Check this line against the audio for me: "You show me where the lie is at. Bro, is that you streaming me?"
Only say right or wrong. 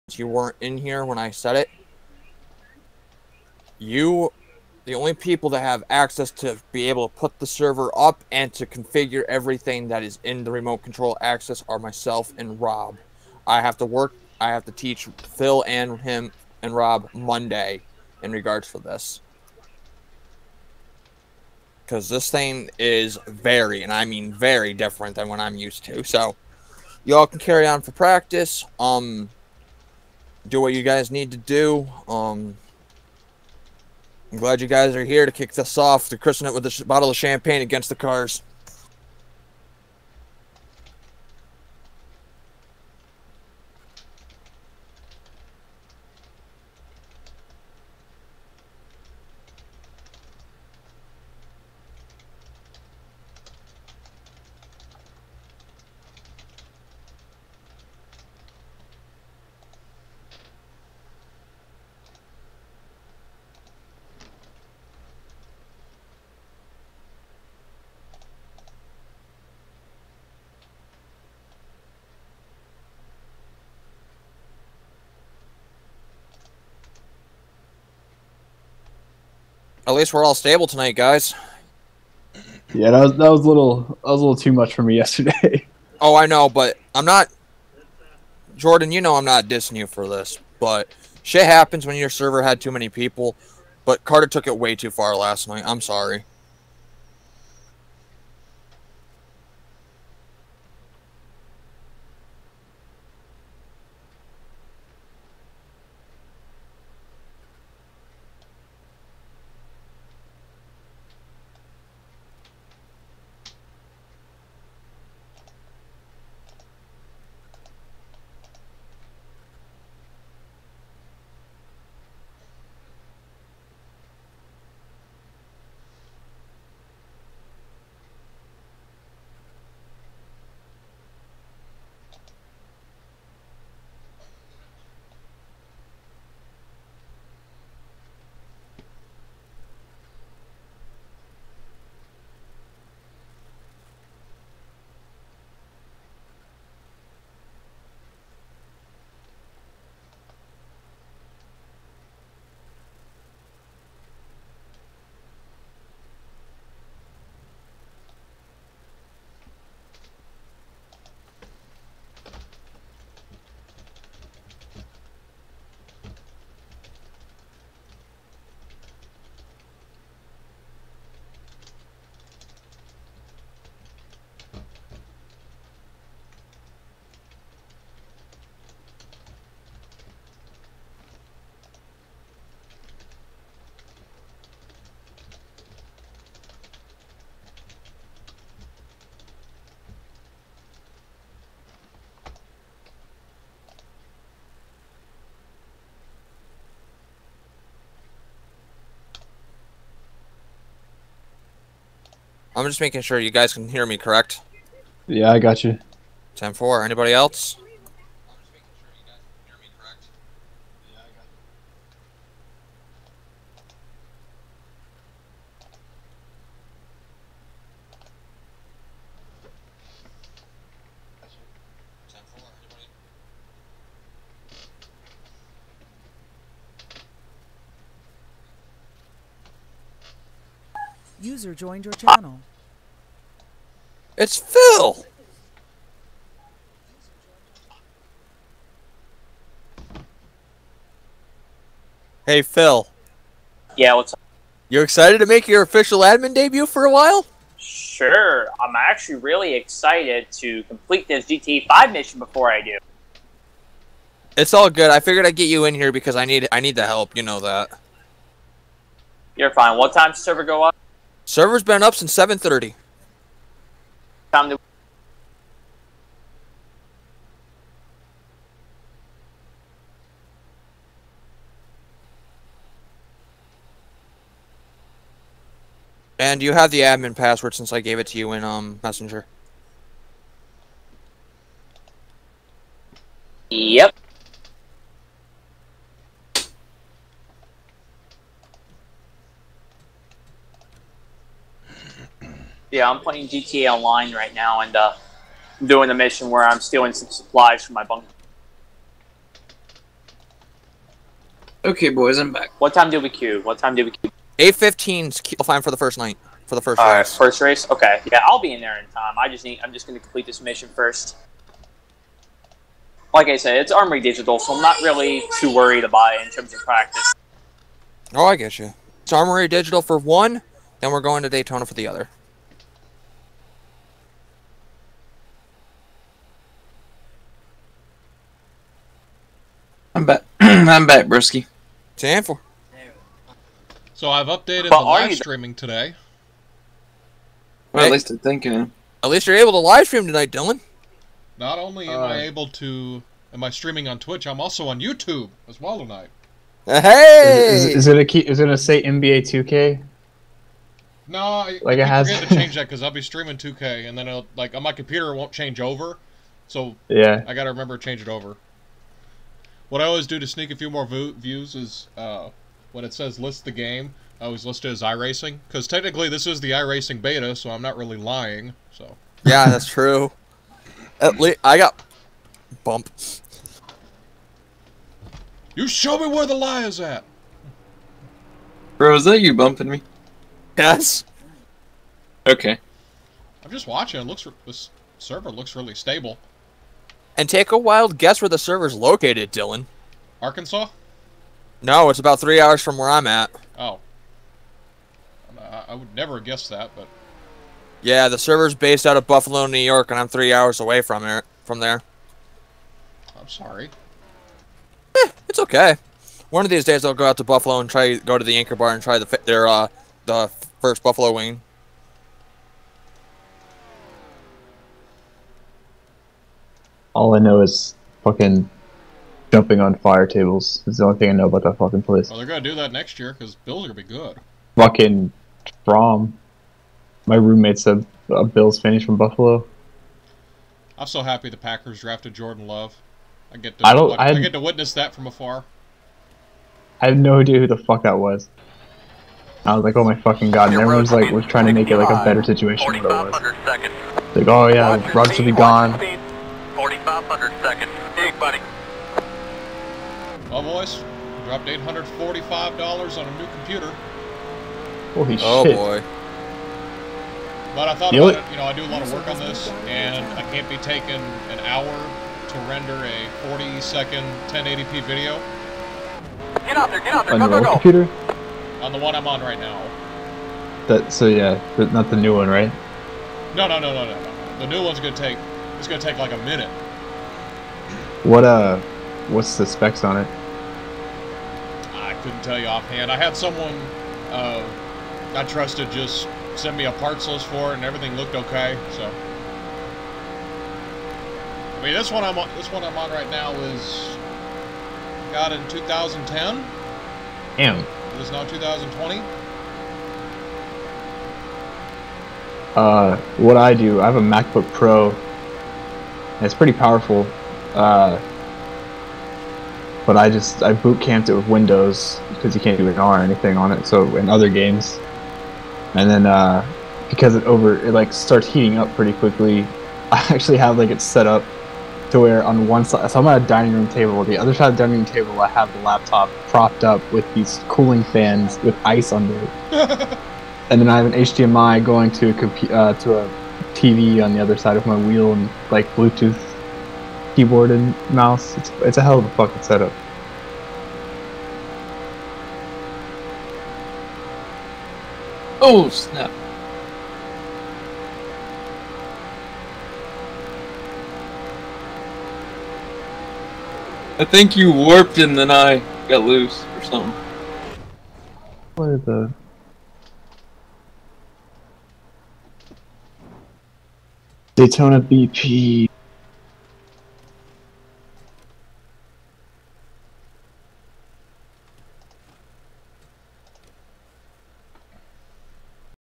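wrong.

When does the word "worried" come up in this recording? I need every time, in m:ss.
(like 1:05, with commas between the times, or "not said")
5:15.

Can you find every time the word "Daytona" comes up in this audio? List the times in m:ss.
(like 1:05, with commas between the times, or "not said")
5:21, 9:24.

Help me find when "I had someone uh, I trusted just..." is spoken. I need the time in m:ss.
8:02.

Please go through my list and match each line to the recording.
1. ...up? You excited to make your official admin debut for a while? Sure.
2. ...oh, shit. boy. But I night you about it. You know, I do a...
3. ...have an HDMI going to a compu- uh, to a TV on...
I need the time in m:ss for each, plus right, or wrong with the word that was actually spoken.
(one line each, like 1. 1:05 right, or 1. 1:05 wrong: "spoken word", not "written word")
1. 4:04 right
2. 7:35 wrong: "thought", not "night"
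3. 8:50 right.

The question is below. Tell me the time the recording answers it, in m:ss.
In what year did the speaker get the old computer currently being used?
8:15.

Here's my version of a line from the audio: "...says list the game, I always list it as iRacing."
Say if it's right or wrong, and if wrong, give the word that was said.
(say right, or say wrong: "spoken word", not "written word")
right.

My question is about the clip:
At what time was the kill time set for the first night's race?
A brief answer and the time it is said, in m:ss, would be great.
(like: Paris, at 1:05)
8:15, at 5:04.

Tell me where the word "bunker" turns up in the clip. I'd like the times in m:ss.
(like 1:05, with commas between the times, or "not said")
4:57.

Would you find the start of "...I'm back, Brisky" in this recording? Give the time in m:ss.
5:30.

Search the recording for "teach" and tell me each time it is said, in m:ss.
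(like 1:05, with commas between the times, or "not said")
0:14.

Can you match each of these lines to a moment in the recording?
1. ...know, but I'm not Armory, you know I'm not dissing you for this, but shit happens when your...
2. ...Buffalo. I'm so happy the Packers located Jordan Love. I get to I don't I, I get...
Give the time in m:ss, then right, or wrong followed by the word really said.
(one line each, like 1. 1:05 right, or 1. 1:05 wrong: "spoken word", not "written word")
1. 1:26 wrong: "Jordan", not "Armory"
2. 7:08 wrong: "drafted", not "located".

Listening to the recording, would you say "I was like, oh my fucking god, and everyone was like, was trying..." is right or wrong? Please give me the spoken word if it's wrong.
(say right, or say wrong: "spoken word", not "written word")
right.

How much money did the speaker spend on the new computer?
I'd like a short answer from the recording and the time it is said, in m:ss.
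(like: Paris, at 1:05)
$845, at 7:31.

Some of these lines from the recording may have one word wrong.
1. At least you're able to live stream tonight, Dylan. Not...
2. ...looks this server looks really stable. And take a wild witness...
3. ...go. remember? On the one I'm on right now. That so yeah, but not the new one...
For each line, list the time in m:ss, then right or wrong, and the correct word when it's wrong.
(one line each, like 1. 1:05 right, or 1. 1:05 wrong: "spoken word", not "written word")
1. 5:39 right
2. 6:24 wrong: "guess", not "witness"
3. 7:47 wrong: "computer", not "remember".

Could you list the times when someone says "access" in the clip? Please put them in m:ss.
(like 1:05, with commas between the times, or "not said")
0:05, 0:11.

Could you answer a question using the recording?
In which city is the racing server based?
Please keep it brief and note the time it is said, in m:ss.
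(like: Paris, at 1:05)
Buffalo, New York, at 6:39.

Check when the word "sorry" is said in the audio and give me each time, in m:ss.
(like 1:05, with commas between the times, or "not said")
1:35, 6:43.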